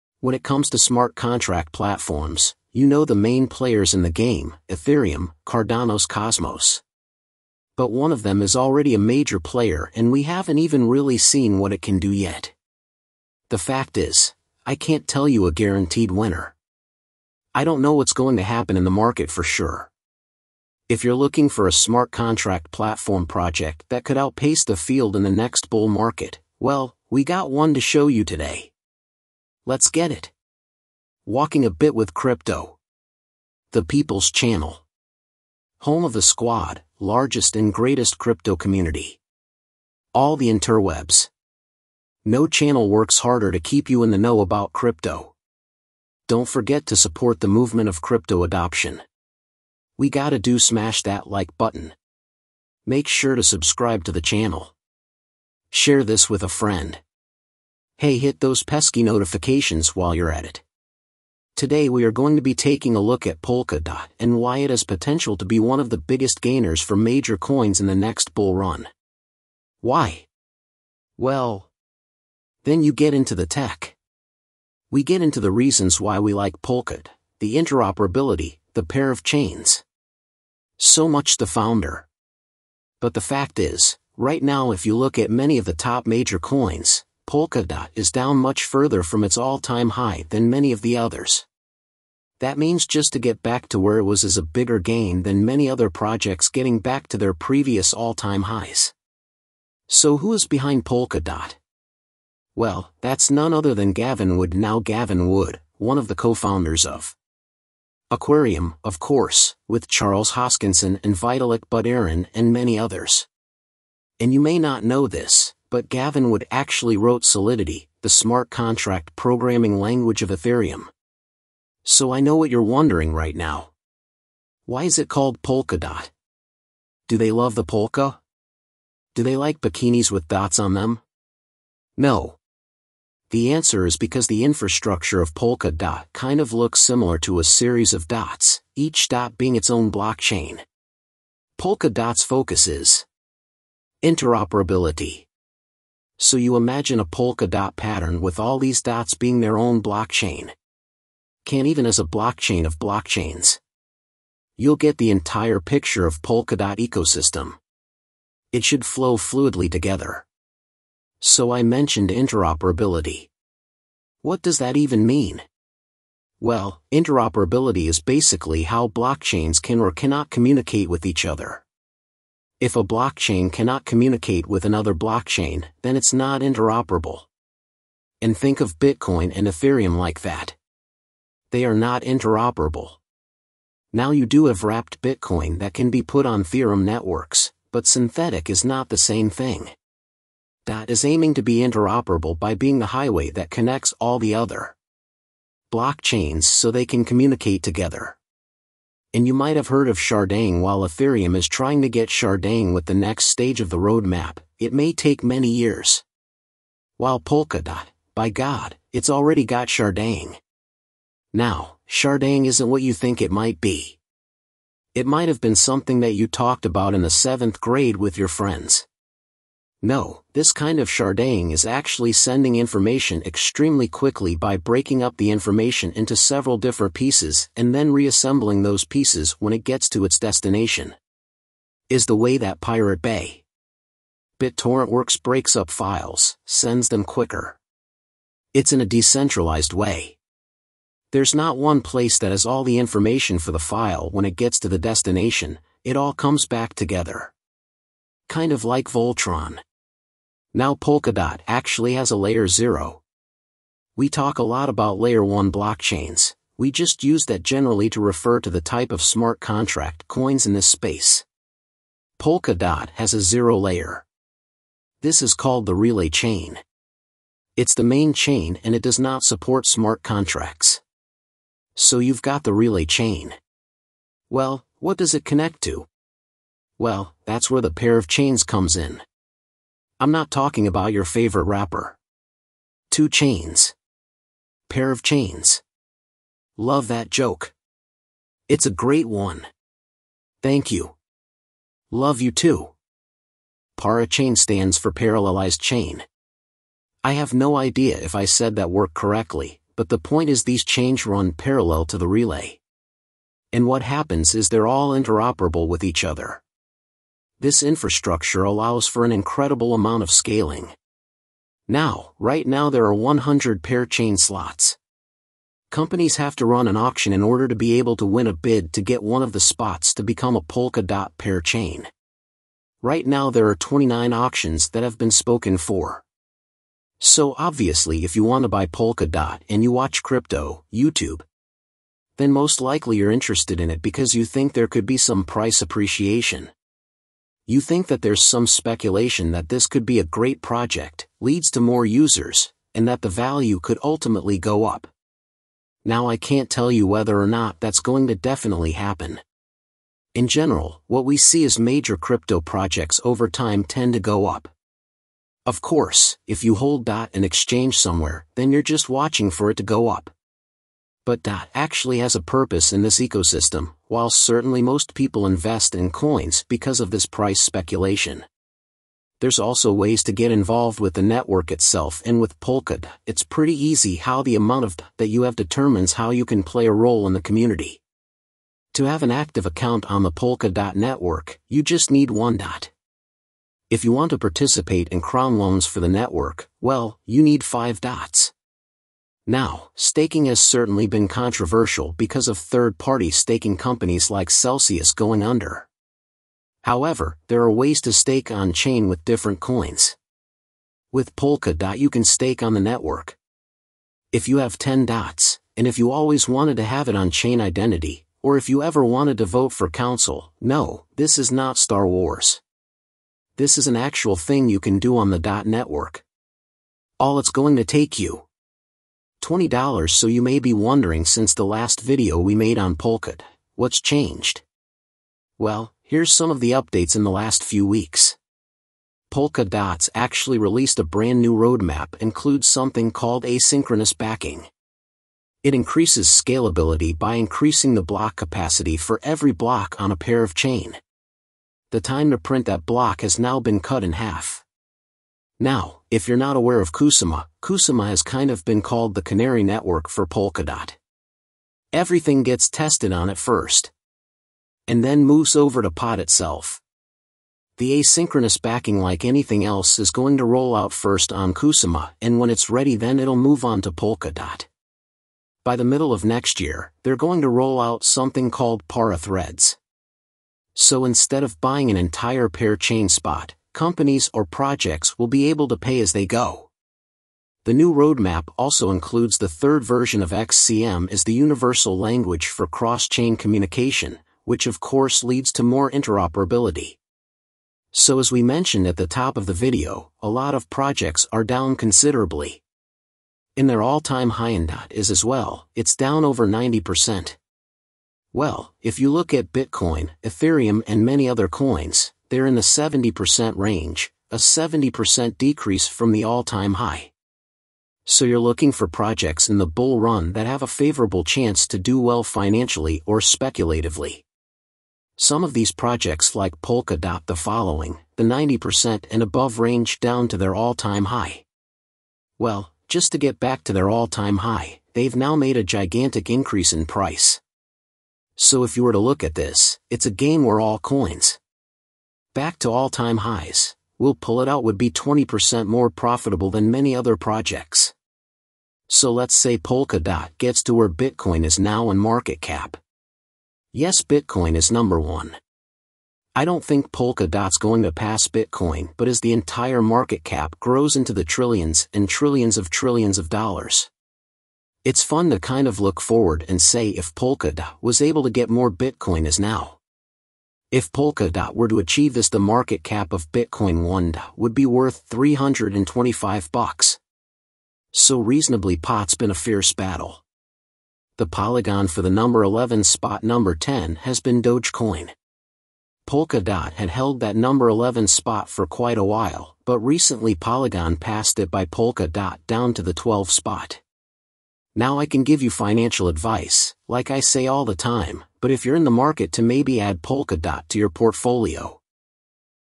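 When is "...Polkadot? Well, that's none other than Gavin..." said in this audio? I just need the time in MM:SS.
01:40.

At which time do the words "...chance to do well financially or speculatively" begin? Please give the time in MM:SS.
08:31.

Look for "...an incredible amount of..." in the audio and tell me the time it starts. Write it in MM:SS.
05:09.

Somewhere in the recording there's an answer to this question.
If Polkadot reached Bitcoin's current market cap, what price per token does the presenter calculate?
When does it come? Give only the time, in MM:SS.
09:24.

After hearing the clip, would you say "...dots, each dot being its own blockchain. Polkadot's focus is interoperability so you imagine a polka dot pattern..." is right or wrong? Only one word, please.
right.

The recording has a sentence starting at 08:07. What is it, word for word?
So as we mentioned at the top of the video, a lot of projects are down considerably.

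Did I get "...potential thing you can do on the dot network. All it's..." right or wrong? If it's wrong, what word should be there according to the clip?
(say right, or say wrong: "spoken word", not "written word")
wrong: "actual", not "potential".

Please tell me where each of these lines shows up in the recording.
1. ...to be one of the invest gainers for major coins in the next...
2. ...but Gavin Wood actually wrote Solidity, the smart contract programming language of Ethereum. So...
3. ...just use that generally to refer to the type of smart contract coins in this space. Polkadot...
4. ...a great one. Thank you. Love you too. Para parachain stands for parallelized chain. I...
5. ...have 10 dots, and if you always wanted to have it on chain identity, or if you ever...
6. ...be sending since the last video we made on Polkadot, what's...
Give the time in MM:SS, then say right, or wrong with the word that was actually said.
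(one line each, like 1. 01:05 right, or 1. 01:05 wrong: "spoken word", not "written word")
1. 01:05 wrong: "biggest", not "invest"
2. 01:55 right
3. 04:16 right
4. 04:48 wrong: "chain", not "parachain"
5. 06:44 right
6. 07:00 wrong: "wondering", not "sending".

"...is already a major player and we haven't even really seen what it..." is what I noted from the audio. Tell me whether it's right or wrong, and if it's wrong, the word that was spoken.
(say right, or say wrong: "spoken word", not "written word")
right.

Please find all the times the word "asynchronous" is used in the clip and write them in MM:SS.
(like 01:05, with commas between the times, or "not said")
07:13, 07:37.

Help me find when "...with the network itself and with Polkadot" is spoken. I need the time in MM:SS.
06:10.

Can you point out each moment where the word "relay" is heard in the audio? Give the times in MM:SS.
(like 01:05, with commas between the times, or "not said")
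04:25, 04:32, 05:02.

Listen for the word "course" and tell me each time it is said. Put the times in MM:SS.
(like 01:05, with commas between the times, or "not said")
01:48, 05:55, 08:04.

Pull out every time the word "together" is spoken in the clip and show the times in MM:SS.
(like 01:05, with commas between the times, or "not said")
02:39, 03:17, 04:06.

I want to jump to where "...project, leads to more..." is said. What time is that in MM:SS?
05:40.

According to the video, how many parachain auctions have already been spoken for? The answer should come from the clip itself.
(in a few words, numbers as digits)
29.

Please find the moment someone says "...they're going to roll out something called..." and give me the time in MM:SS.
07:46.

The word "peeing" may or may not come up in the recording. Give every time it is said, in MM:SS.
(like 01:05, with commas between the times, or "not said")
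not said.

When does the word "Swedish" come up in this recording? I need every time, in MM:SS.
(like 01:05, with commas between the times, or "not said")
not said.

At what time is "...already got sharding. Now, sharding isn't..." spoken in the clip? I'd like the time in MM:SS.
03:29.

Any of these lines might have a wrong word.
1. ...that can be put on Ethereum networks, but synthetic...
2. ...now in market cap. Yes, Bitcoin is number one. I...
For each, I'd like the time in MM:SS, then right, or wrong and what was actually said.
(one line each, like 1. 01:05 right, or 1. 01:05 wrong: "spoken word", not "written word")
1. 03:05 right
2. 09:01 right.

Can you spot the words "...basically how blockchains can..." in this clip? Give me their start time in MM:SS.
02:47.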